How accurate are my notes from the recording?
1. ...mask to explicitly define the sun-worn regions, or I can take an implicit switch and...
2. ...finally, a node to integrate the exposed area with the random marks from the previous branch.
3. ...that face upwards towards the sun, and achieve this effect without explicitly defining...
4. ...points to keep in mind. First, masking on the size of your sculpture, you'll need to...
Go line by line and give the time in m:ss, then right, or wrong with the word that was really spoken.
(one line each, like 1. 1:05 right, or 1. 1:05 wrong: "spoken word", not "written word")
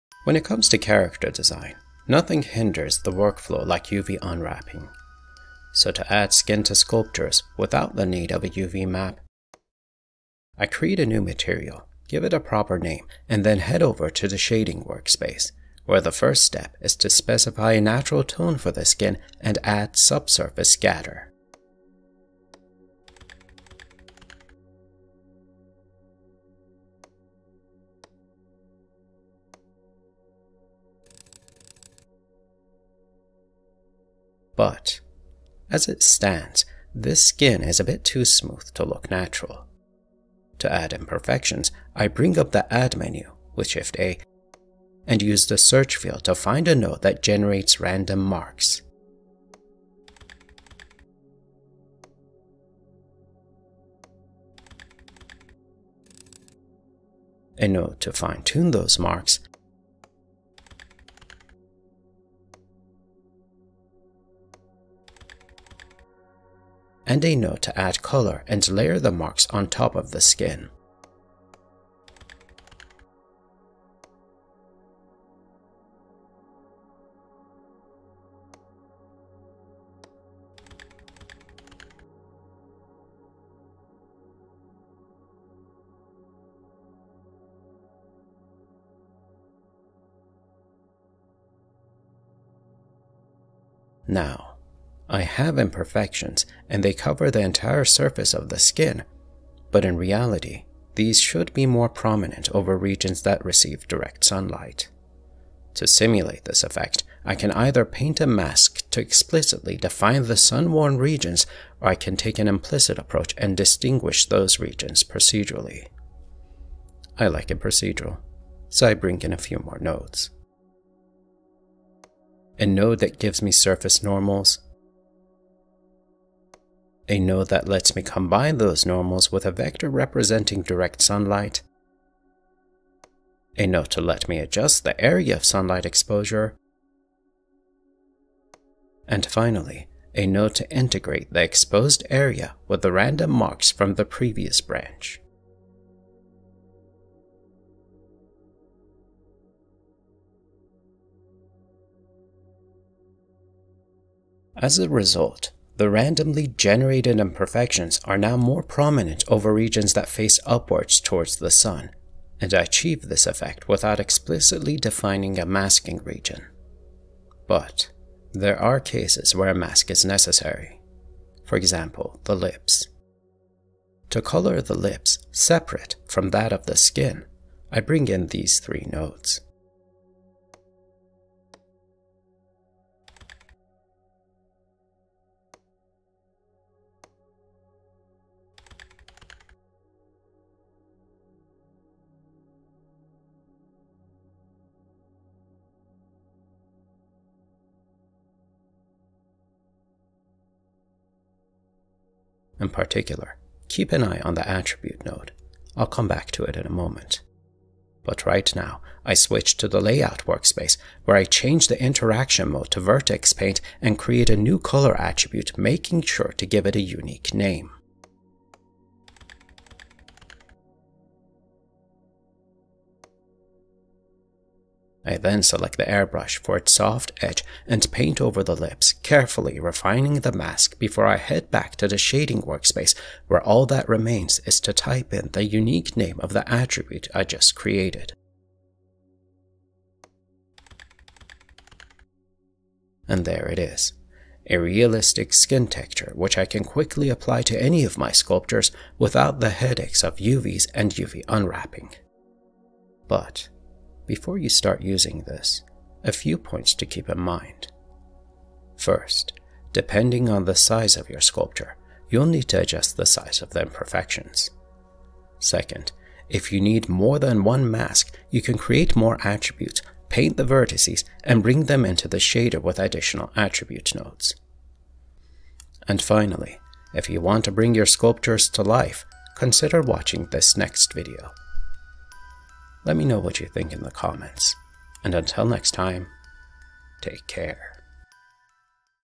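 1. 1:48 wrong: "approach", not "switch"
2. 2:19 right
3. 2:39 right
4. 4:16 wrong: "depending", not "masking".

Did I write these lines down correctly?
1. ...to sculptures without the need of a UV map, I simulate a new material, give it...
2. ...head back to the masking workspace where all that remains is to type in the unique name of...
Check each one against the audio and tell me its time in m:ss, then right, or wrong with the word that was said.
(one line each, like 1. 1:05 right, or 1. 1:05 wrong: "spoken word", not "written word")
1. 0:06 wrong: "create", not "simulate"
2. 3:51 wrong: "shading", not "masking".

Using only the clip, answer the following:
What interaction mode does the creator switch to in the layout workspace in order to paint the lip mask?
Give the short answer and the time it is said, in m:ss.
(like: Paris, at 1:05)
Vertex paint, at 3:32.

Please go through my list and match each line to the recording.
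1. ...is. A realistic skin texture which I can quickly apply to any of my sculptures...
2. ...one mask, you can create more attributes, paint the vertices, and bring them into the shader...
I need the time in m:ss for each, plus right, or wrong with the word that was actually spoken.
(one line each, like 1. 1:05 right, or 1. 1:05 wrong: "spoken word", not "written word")
1. 4:03 right
2. 4:27 right.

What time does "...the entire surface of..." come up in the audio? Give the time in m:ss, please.
1:37.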